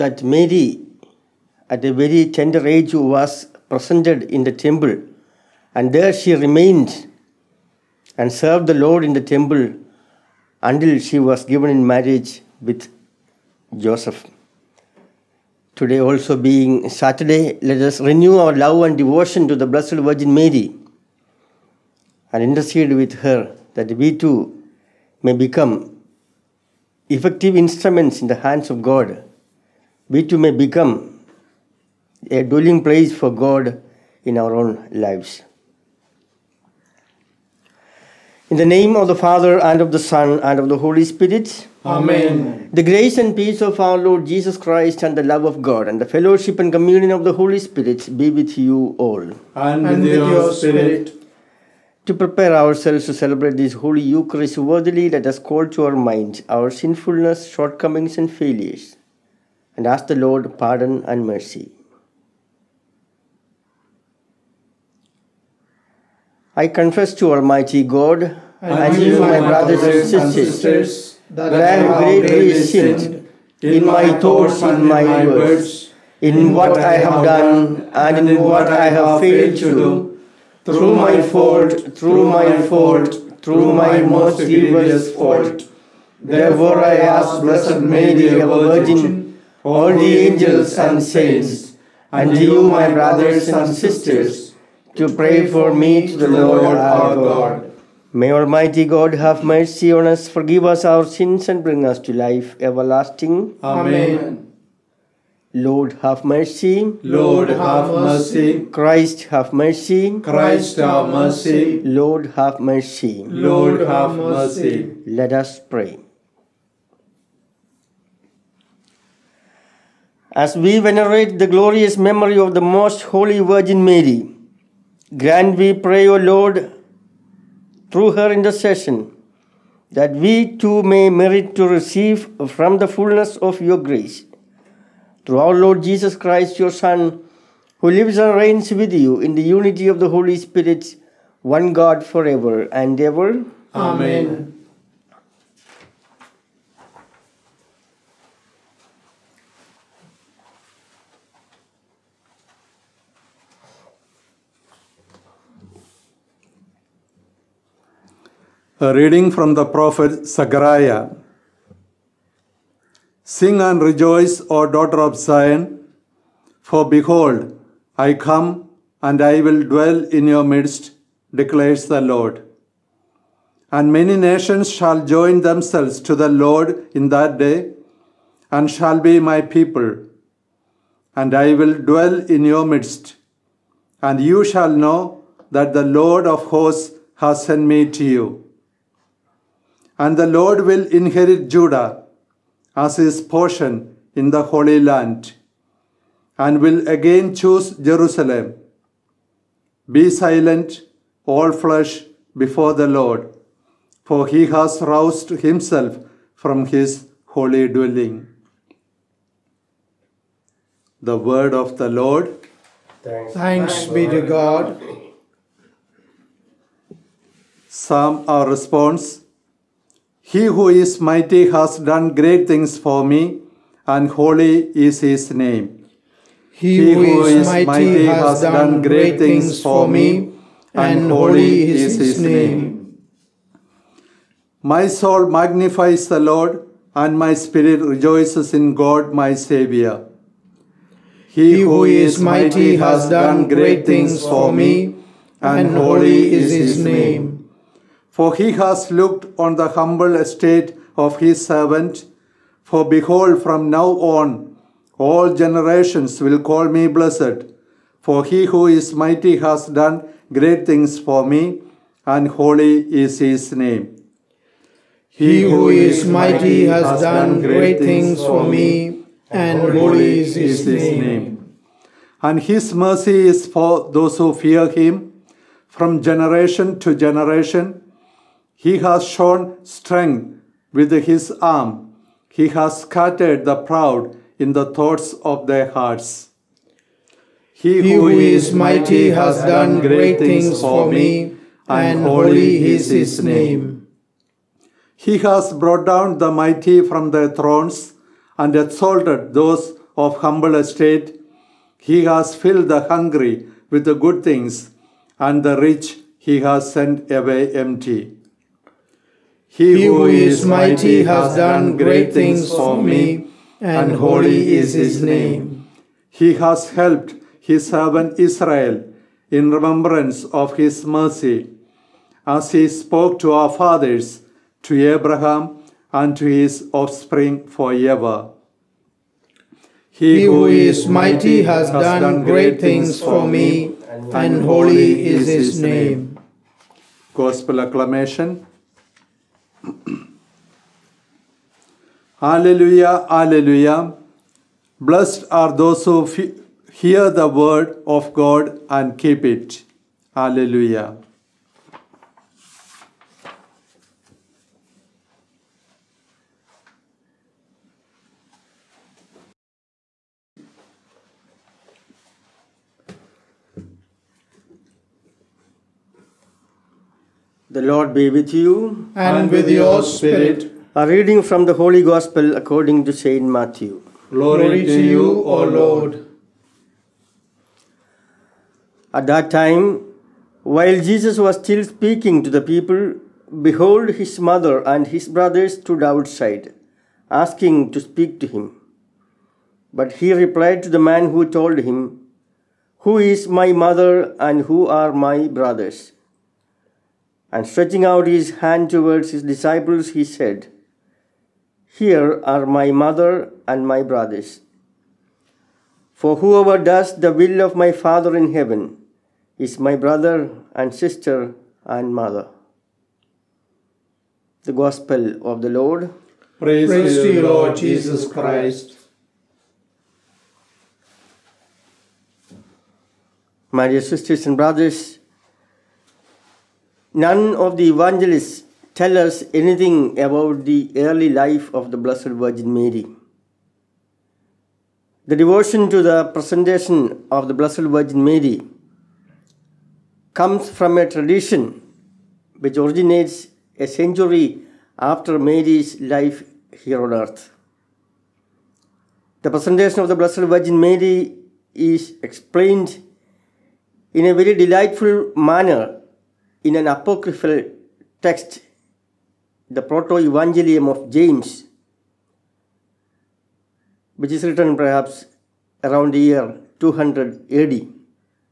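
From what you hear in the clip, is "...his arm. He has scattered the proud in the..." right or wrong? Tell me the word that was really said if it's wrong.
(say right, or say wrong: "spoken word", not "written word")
right.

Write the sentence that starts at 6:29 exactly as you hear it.
But he replied to the man who told him, Who is my mother and who are my brothers?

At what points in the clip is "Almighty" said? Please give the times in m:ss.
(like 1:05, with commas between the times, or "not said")
1:07, 1:38.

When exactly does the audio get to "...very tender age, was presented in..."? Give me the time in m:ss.
0:01.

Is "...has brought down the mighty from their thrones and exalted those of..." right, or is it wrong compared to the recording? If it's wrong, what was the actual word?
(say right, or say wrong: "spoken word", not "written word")
right.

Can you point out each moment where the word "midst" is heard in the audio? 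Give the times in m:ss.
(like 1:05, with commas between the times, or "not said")
2:50, 3:02.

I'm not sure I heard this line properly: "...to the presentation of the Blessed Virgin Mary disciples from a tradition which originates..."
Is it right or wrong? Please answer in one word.
wrong.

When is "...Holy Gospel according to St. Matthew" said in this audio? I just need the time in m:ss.
6:11.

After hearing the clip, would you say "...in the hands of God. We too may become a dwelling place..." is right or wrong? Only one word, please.
right.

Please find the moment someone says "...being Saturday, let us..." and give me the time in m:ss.
0:16.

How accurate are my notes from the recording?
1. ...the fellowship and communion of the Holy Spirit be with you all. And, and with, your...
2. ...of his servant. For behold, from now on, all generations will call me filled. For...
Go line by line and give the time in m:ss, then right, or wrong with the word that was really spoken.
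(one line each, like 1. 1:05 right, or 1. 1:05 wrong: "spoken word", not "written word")
1. 0:46 right
2. 4:10 wrong: "blessed", not "filled".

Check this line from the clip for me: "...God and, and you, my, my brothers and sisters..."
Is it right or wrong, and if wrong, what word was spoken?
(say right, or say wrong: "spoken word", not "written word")
right.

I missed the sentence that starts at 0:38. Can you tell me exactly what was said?
In the name of the Father, and of the Son, and of the Holy Spirit.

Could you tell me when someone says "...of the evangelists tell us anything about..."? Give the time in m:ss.
7:07.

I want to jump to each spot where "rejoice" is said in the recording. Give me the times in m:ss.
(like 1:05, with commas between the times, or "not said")
2:43, 3:57.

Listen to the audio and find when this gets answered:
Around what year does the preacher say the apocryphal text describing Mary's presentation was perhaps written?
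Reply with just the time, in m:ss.
7:46.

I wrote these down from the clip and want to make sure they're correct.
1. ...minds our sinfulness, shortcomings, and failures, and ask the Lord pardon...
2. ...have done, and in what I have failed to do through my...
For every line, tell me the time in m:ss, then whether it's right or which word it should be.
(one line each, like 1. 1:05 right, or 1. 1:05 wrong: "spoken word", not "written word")
1. 0:55 right
2. 1:16 right.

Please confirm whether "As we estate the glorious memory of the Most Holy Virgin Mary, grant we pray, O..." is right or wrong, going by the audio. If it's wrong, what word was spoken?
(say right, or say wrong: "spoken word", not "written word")
wrong: "venerate", not "estate".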